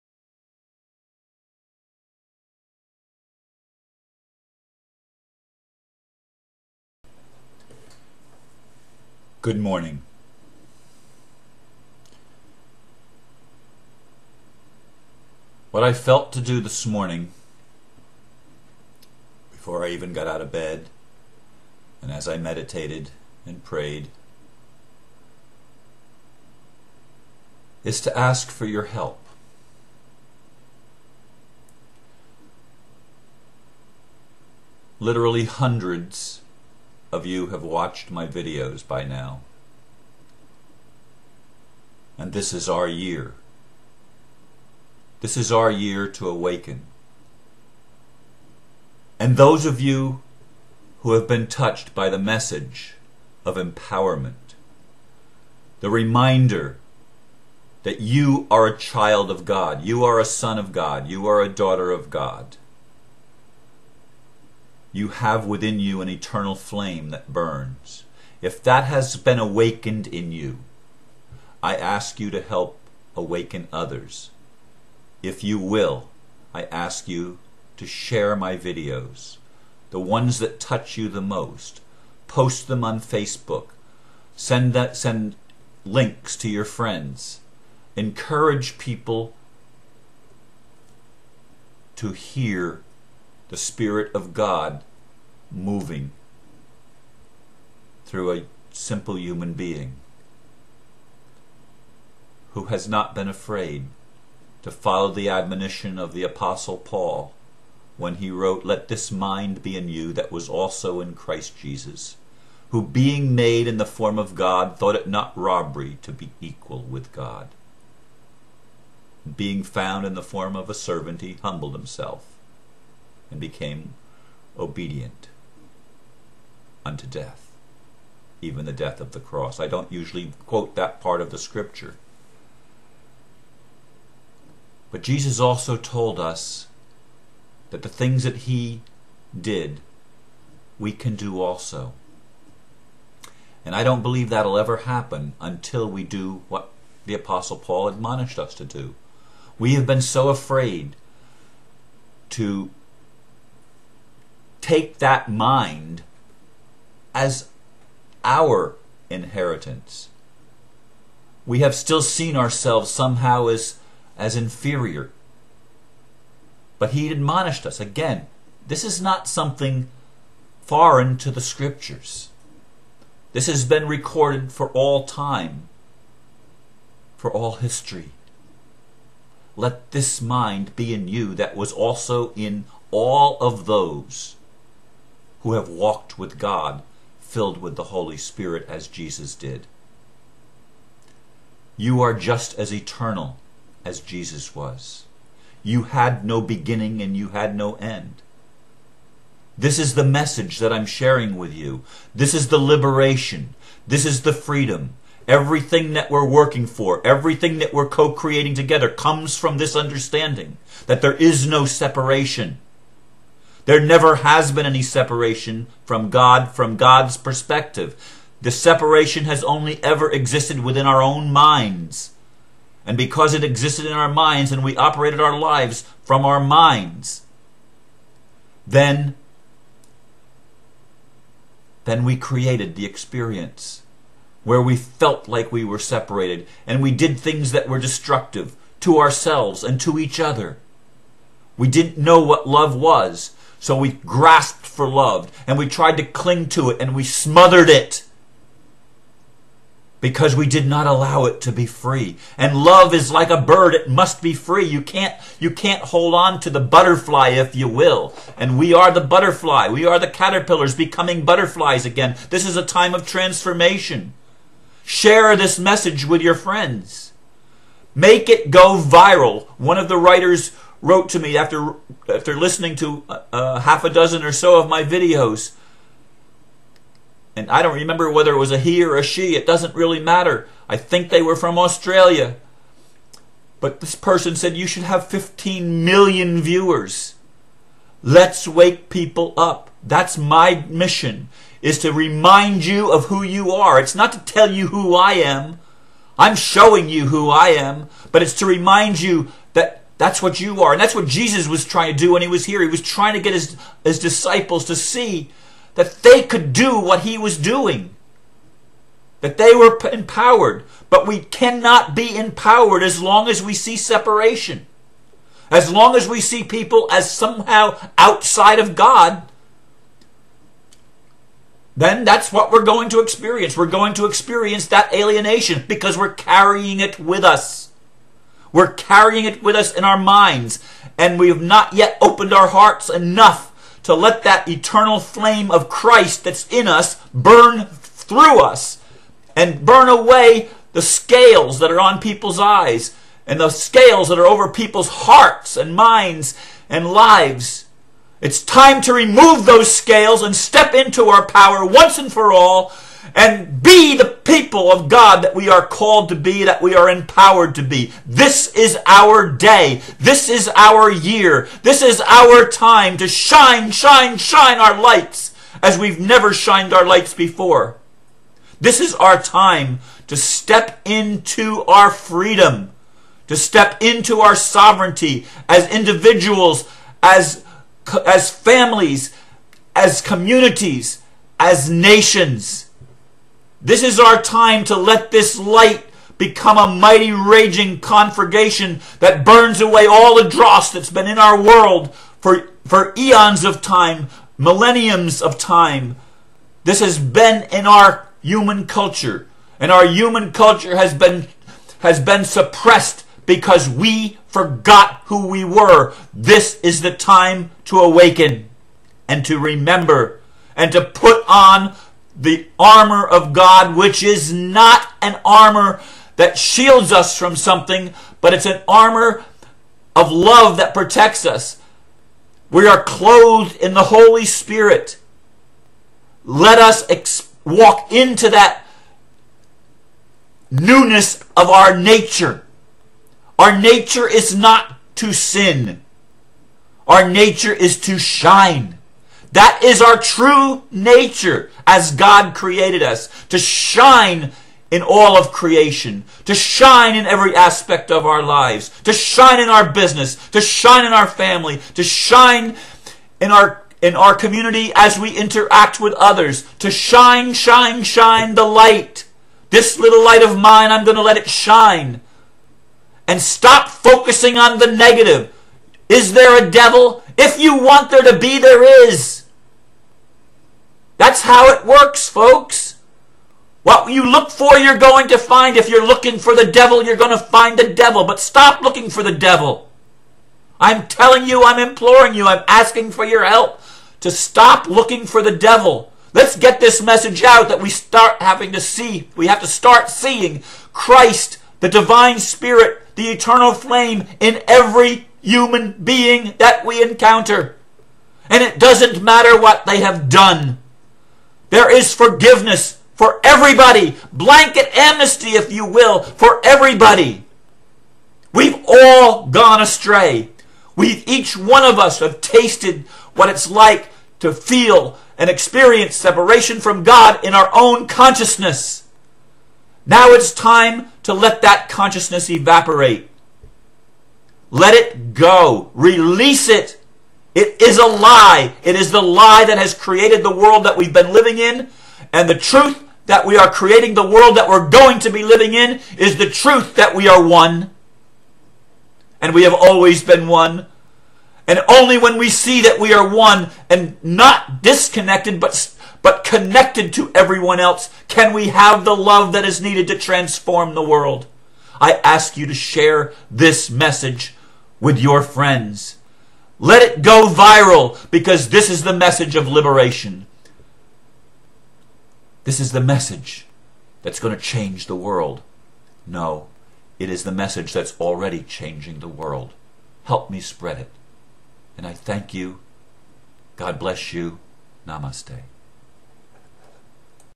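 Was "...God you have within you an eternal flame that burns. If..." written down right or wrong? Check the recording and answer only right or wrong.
right.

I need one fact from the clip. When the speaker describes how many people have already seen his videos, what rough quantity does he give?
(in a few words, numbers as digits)
Hundreds.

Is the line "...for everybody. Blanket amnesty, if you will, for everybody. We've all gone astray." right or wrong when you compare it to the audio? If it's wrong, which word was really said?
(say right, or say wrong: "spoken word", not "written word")
right.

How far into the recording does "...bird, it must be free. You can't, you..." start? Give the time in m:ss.
4:13.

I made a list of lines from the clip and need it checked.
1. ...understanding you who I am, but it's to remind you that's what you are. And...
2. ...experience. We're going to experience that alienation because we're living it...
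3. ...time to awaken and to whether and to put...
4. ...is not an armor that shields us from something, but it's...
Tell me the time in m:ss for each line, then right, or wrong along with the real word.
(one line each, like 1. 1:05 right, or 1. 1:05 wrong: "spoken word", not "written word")
1. 4:56 wrong: "showing", not "understanding"
2. 5:23 wrong: "carrying", not "living"
3. 6:46 wrong: "remember", not "whether"
4. 6:54 right.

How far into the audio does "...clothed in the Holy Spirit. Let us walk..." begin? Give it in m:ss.
7:02.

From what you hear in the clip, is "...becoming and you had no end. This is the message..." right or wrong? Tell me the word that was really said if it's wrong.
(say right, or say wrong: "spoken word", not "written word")
wrong: "beginning", not "becoming".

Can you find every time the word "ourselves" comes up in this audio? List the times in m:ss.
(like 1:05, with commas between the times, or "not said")
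2:42, 3:58.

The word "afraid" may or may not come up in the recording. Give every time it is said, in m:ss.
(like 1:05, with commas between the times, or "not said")
1:43, 2:30.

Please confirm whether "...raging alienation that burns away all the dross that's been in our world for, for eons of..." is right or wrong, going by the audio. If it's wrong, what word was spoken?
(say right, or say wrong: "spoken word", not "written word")
wrong: "conflagration", not "alienation".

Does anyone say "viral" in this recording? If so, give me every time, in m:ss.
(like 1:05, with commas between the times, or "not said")
4:28, 9:17.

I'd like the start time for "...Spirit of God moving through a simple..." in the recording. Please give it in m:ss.
1:33.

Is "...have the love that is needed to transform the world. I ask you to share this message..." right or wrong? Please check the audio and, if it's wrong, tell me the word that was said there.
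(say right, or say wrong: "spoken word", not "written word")
right.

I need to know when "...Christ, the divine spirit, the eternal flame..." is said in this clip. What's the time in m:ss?
8:10.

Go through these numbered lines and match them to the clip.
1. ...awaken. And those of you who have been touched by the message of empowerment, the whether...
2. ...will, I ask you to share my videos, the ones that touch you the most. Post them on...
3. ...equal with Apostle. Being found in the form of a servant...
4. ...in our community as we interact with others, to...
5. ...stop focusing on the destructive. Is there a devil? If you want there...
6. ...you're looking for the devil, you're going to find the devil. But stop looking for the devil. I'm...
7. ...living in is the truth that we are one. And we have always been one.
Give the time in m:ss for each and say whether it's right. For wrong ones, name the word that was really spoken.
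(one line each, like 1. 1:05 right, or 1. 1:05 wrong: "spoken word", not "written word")
1. 0:46 wrong: "reminder", not "whether"
2. 1:15 right
3. 1:56 wrong: "God", not "Apostle"
4. 7:33 right
5. 7:43 wrong: "negative", not "destructive"
6. 7:55 right
7. 8:55 right.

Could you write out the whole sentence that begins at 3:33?
There never has been any separation from God from God's perspective.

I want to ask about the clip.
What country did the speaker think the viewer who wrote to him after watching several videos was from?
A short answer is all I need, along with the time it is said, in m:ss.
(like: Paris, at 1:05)
Australia, at 4:41.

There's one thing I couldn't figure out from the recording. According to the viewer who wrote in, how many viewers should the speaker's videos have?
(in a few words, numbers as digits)
15 million.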